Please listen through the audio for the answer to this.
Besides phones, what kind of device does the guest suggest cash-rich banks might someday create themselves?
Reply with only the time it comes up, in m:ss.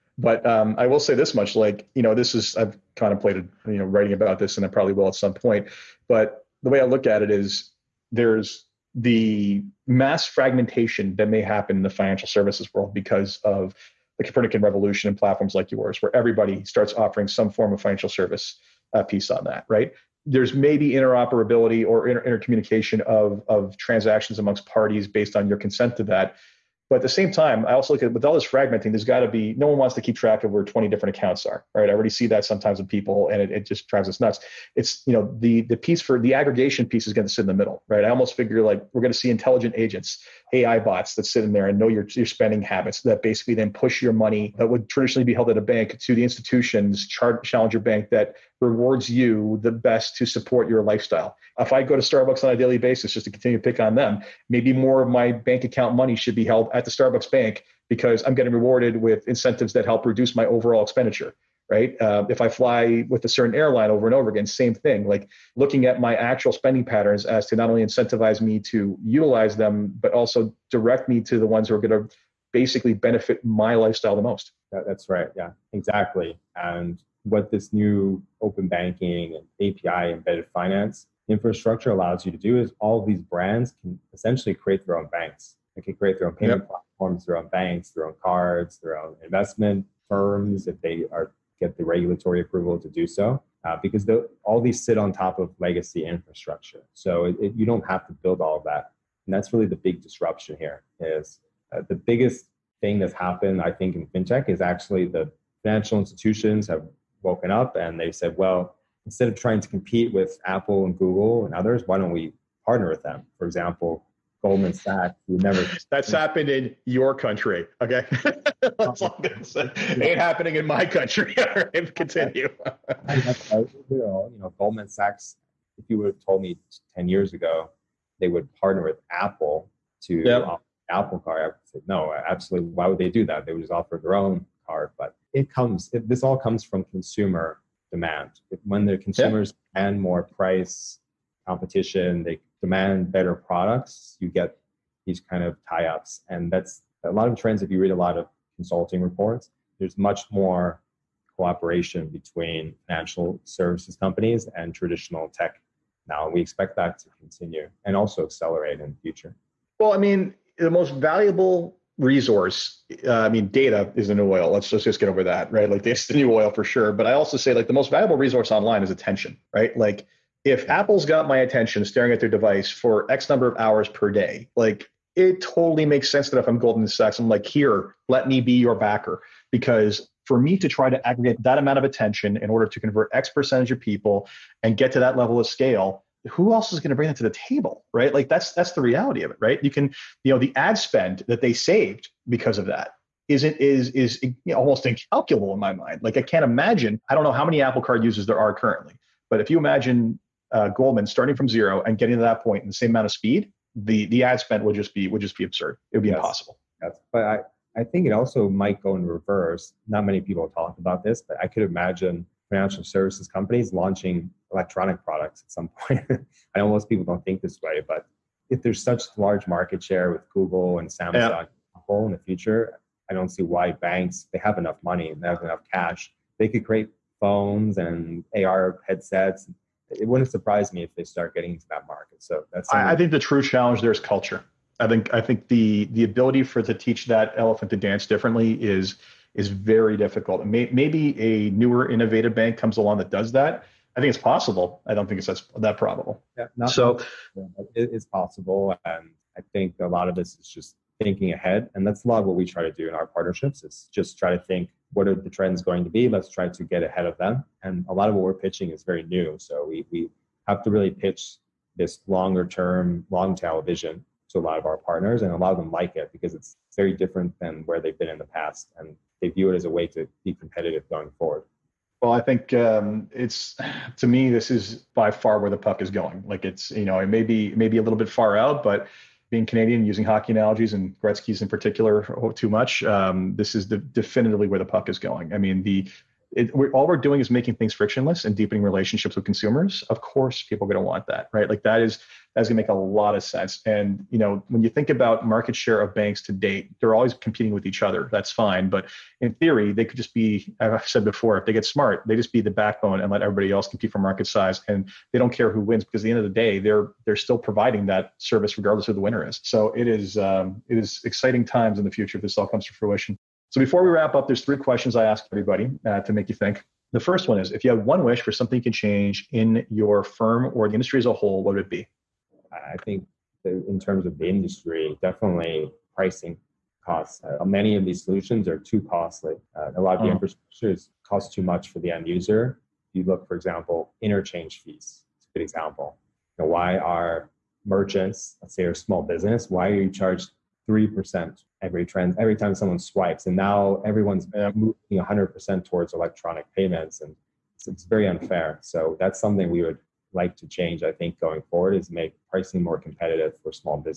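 3:48.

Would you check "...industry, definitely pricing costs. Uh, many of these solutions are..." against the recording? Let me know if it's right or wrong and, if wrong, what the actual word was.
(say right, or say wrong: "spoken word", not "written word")
right.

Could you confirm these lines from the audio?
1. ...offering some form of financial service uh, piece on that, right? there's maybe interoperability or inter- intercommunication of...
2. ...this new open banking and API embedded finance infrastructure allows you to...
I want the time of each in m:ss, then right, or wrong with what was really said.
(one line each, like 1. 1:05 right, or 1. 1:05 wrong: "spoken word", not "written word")
1. 0:16 right
2. 1:17 right.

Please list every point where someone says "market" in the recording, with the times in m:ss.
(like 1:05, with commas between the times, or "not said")
3:39, 3:51, 4:55, 5:03.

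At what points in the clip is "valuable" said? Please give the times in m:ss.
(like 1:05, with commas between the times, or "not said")
2:40, 2:47.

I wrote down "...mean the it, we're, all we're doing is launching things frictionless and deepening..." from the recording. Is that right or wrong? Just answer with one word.
wrong.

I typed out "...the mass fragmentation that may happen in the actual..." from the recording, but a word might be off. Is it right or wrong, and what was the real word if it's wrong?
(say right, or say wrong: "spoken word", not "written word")
wrong: "financial", not "actual".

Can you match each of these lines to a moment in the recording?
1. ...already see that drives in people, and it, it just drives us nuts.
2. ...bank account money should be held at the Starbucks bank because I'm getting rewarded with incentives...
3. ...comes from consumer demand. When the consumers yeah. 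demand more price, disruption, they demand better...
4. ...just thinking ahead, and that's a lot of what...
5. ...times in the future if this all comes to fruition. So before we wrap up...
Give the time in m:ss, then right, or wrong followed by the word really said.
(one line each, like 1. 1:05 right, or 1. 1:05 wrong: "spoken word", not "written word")
1. 0:31 wrong: "sometimes", not "drives"
2. 0:55 right
3. 2:16 wrong: "competition", not "disruption"
4. 4:10 right
5. 5:11 right.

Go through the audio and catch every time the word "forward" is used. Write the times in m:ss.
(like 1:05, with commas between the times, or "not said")
4:31, 5:51.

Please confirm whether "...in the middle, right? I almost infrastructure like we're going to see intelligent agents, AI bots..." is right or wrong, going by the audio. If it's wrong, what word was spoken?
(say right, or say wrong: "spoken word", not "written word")
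wrong: "figure", not "infrastructure".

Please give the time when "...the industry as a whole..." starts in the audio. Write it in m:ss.
5:20.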